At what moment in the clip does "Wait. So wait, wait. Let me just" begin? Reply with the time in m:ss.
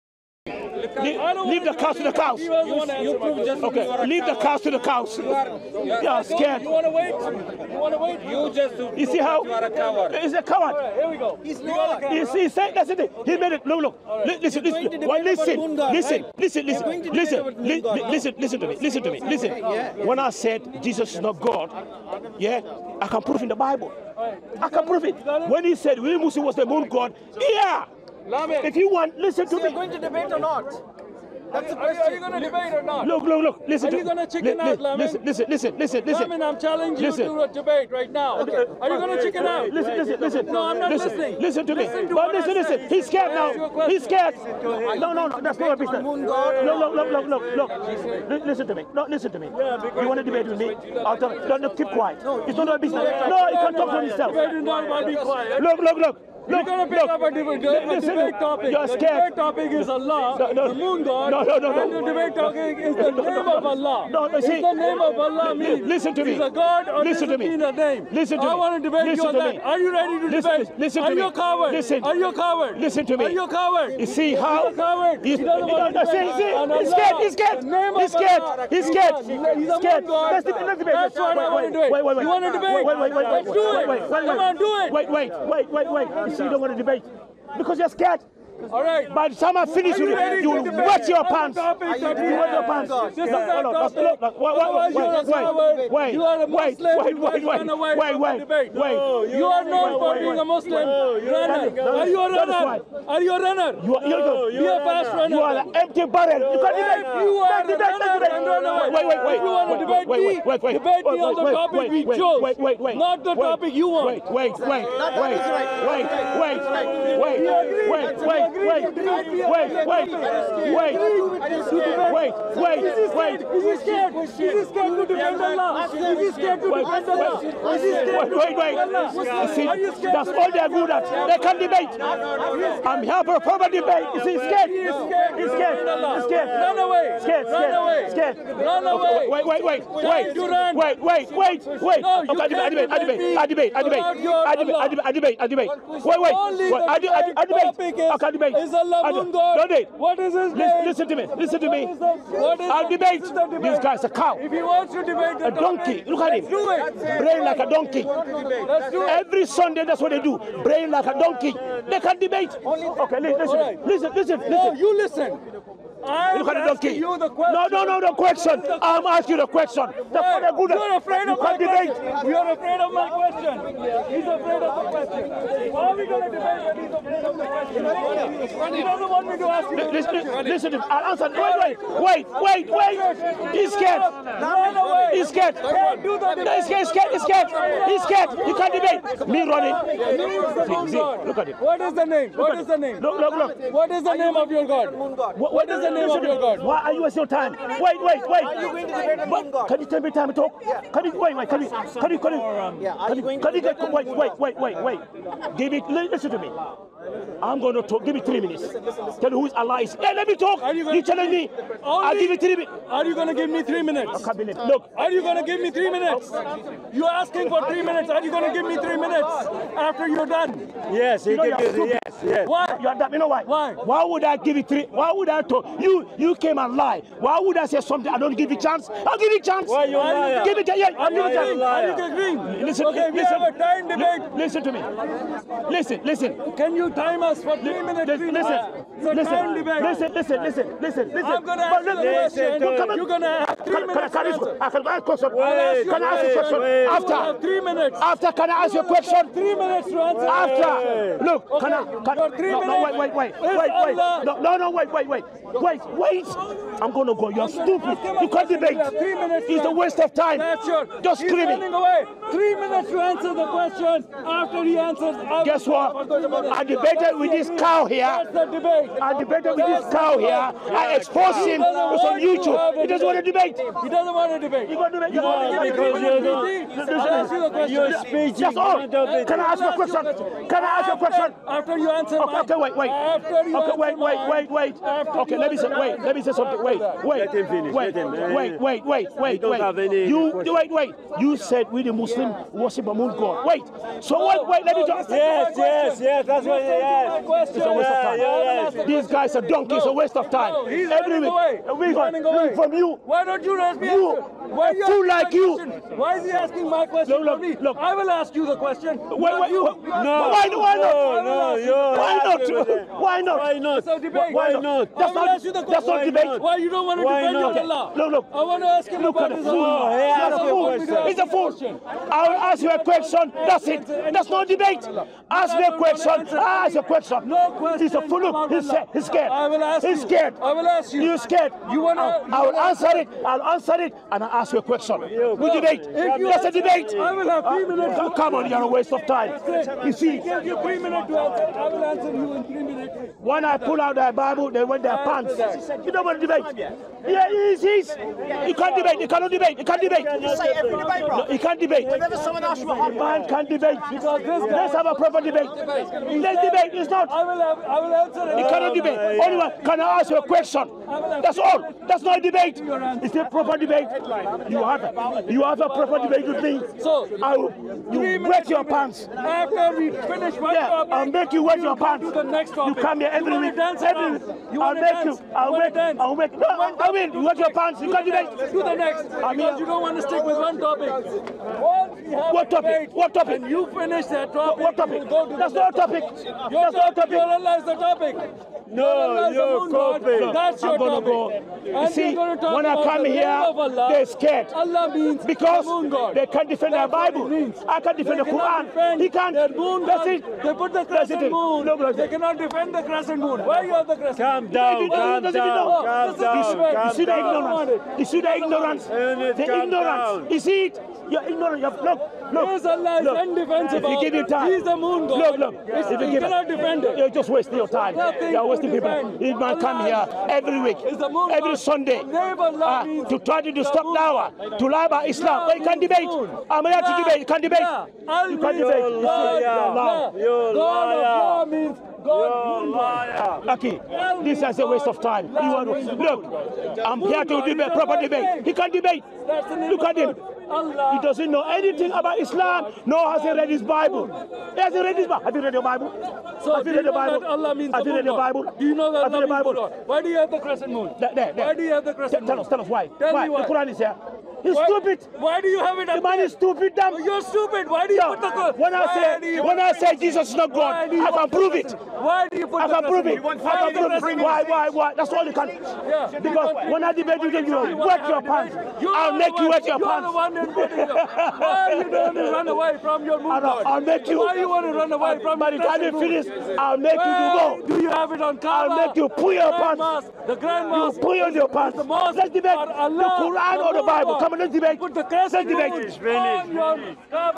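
4:53.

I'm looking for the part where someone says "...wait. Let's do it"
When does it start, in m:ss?
1:23.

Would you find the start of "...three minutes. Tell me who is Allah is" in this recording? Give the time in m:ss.
3:28.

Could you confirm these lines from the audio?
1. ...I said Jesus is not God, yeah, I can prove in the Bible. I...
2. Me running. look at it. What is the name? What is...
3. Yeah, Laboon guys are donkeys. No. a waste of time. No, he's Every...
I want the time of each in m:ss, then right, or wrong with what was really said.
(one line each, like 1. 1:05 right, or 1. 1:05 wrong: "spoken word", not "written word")
1. 0:20 right
2. 3:09 right
3. 4:58 wrong: "These", not "Laboon".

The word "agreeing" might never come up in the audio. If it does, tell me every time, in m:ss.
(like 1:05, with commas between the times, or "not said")
3:52.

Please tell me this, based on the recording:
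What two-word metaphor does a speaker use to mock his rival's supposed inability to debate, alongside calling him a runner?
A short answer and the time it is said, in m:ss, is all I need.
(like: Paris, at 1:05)
empty barrel, at 1:45.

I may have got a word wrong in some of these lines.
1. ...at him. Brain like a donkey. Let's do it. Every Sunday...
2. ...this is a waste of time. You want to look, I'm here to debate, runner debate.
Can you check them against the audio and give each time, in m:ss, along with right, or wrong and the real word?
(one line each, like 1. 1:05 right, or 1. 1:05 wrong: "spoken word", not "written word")
1. 2:36 right
2. 7:14 wrong: "proper", not "runner".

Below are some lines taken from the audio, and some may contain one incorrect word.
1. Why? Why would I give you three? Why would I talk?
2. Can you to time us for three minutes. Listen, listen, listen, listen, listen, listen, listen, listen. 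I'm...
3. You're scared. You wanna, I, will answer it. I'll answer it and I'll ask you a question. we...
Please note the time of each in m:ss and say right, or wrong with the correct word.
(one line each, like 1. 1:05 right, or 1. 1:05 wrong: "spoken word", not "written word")
1. 3:43 right
2. 3:56 right
3. 5:31 right.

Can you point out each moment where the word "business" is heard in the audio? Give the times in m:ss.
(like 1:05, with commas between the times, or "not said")
0:45, 0:52.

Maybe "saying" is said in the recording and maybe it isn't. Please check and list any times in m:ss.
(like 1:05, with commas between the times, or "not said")
0:12.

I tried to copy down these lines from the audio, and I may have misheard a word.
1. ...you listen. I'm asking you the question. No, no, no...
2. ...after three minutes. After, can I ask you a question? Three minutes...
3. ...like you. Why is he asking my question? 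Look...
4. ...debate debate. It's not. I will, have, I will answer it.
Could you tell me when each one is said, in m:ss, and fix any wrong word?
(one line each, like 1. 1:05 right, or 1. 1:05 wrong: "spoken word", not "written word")
1. 2:44 right
2. 4:06 right
3. 5:05 right
4. 5:55 right.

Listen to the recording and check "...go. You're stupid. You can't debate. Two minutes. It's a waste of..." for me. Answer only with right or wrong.
wrong.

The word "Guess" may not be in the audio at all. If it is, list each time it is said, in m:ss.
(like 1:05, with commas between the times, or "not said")
4:25.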